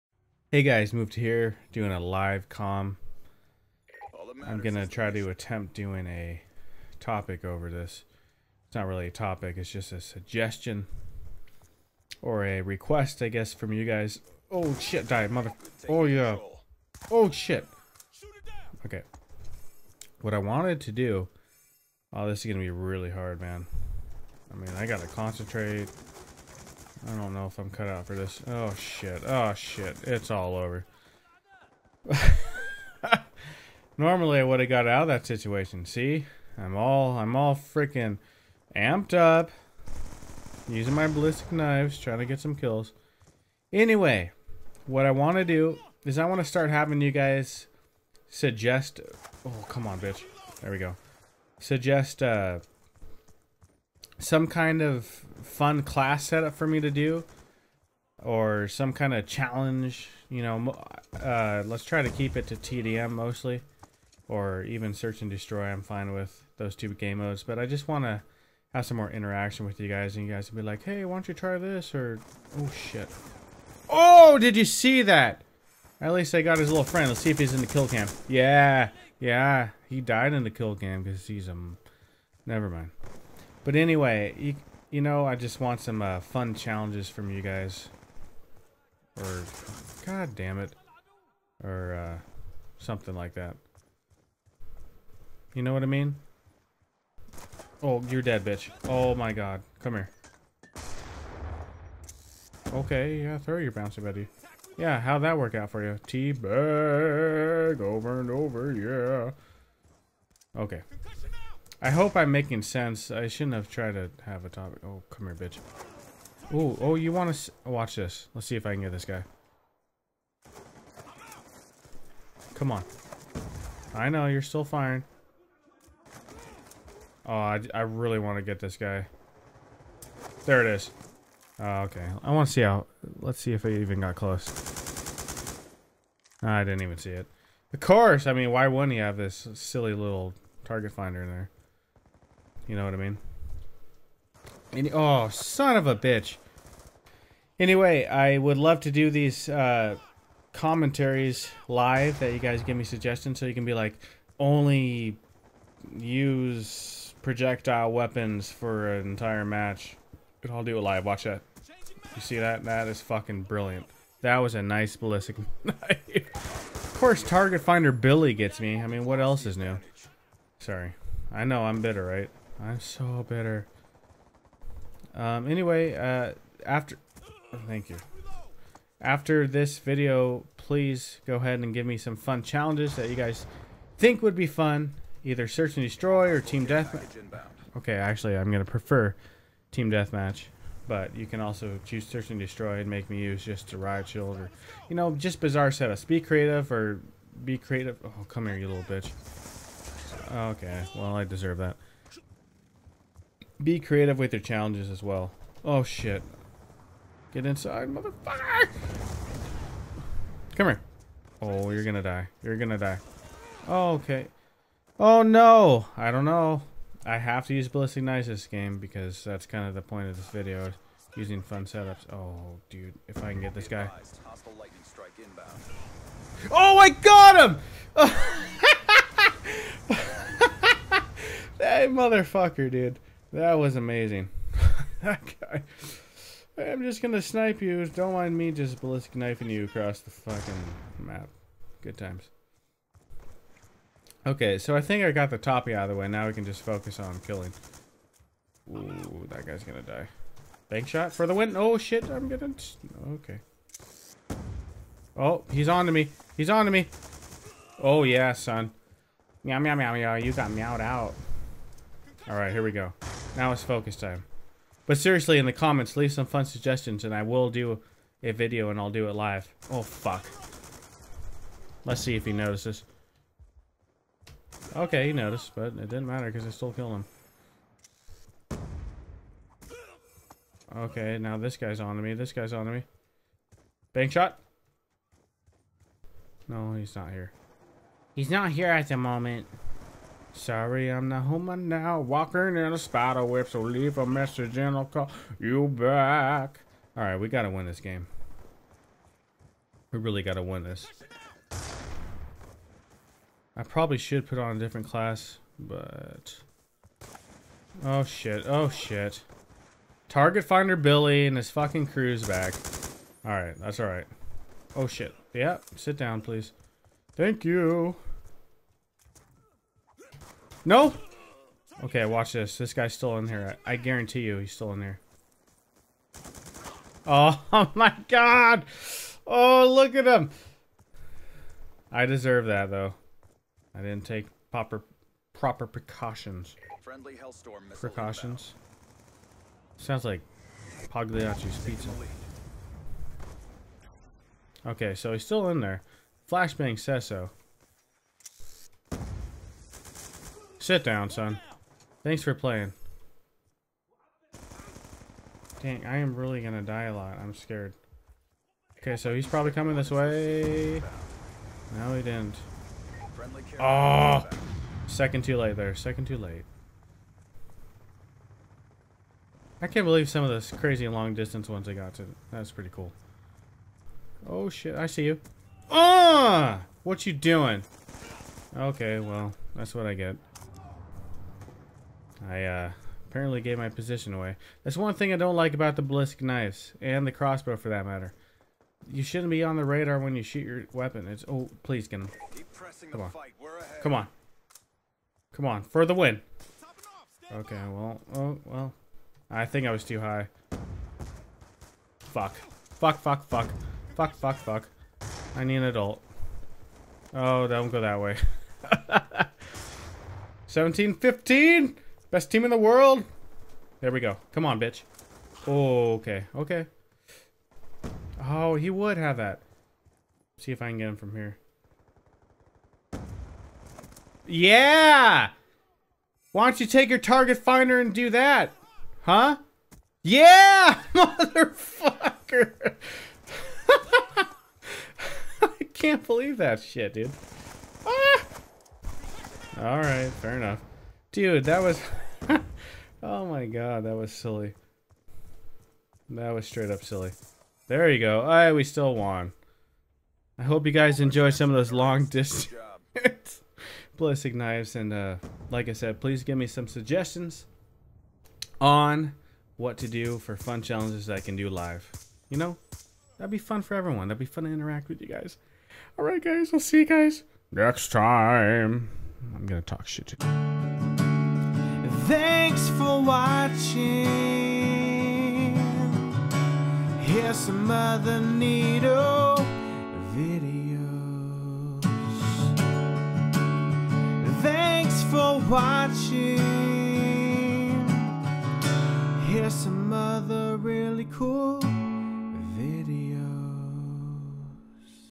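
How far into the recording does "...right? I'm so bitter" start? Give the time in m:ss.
2:52.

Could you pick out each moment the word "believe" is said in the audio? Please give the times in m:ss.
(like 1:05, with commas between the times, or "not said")
6:09, 7:16.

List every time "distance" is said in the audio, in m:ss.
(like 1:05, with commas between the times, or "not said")
6:11, 7:32.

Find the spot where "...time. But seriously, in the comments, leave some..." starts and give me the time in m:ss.
4:23.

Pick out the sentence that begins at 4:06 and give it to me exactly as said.
Now we can just focus on killing.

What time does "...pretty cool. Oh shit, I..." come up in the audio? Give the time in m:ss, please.
6:12.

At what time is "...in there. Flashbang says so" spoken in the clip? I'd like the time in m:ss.
5:45.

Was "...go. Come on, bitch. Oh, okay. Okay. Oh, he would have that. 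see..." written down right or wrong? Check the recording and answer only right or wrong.
right.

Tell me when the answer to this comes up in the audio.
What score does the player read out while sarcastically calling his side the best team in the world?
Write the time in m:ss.
6:50.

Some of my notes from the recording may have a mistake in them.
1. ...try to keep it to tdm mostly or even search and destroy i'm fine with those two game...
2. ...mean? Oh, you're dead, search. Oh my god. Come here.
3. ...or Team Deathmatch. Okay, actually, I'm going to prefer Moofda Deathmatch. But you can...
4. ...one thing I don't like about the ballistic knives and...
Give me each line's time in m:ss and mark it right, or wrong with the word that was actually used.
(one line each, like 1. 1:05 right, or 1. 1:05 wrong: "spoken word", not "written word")
1. 1:01 right
2. 1:35 wrong: "bitch", not "search"
3. 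3:06 wrong: "Team", not "Moofda"
4. 6:24 right.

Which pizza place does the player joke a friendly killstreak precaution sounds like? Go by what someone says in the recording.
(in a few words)
Pagliacci's pizza.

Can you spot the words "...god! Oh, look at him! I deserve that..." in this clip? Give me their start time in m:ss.
5:28.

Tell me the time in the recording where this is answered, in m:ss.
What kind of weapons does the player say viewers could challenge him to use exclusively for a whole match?
2:37.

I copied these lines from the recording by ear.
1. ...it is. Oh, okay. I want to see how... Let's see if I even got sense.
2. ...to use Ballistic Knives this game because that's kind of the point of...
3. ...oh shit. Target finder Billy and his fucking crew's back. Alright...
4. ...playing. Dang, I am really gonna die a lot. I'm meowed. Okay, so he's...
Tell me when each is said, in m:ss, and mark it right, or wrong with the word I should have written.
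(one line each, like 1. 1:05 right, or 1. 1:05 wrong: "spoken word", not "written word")
1. 2:10 wrong: "close", not "sense"
2. 3:37 right
3. 5:08 right
4. 5:52 wrong: "scared", not "meowed".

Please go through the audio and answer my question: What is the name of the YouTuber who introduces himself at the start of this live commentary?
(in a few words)
Moofda.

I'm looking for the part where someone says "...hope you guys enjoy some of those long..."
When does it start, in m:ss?
7:30.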